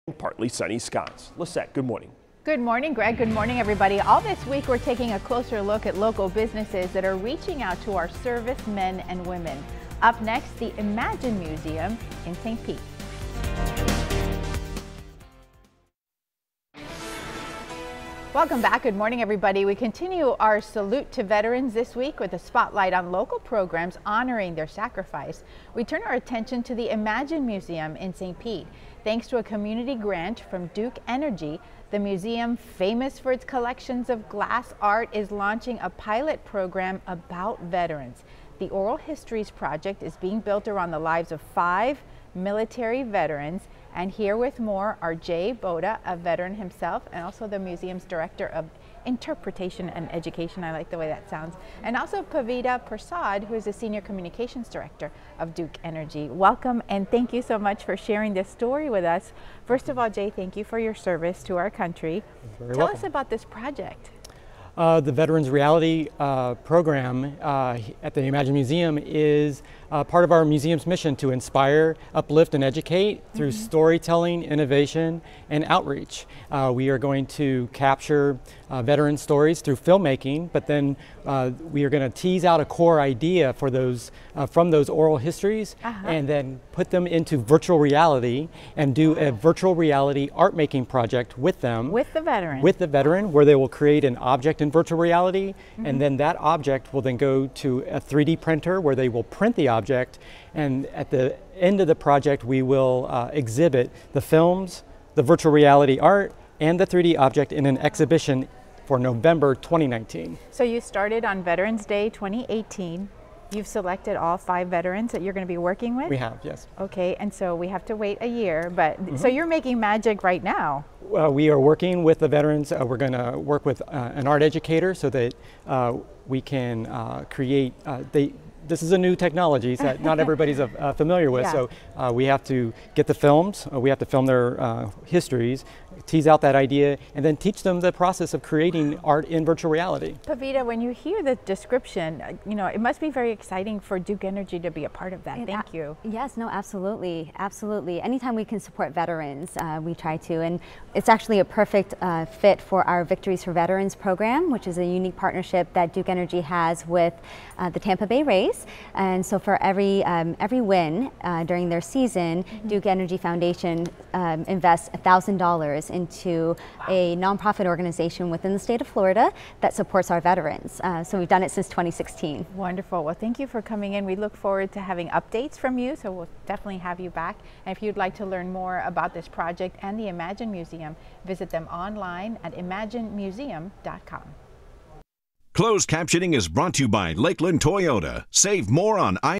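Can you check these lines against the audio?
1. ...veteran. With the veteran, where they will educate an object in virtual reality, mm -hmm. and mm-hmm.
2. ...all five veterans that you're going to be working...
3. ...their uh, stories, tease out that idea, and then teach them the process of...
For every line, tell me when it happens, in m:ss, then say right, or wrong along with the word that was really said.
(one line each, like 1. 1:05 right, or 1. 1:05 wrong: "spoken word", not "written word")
1. 1:32 wrong: "create", not "educate"
2. 1:54 right
3. 2:14 wrong: "histories", not "stories".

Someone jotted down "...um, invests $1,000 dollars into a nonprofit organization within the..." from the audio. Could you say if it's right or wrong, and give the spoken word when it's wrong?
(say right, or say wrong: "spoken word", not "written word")
right.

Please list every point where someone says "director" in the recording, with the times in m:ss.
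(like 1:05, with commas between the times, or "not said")
0:48, 0:54.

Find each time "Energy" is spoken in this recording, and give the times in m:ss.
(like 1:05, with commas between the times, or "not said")
0:31, 0:55, 2:24, 2:36, 2:42.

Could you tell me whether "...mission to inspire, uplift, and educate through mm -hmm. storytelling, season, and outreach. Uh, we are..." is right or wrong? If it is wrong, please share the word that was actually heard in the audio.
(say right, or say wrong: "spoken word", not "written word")
wrong: "innovation", not "season".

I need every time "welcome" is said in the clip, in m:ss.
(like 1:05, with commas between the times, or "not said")
0:18, 0:56, 1:02.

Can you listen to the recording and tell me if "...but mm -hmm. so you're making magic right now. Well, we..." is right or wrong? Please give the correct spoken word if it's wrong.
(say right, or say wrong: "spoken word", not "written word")
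right.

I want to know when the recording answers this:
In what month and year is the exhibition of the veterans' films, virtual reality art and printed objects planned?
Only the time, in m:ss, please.
1:48.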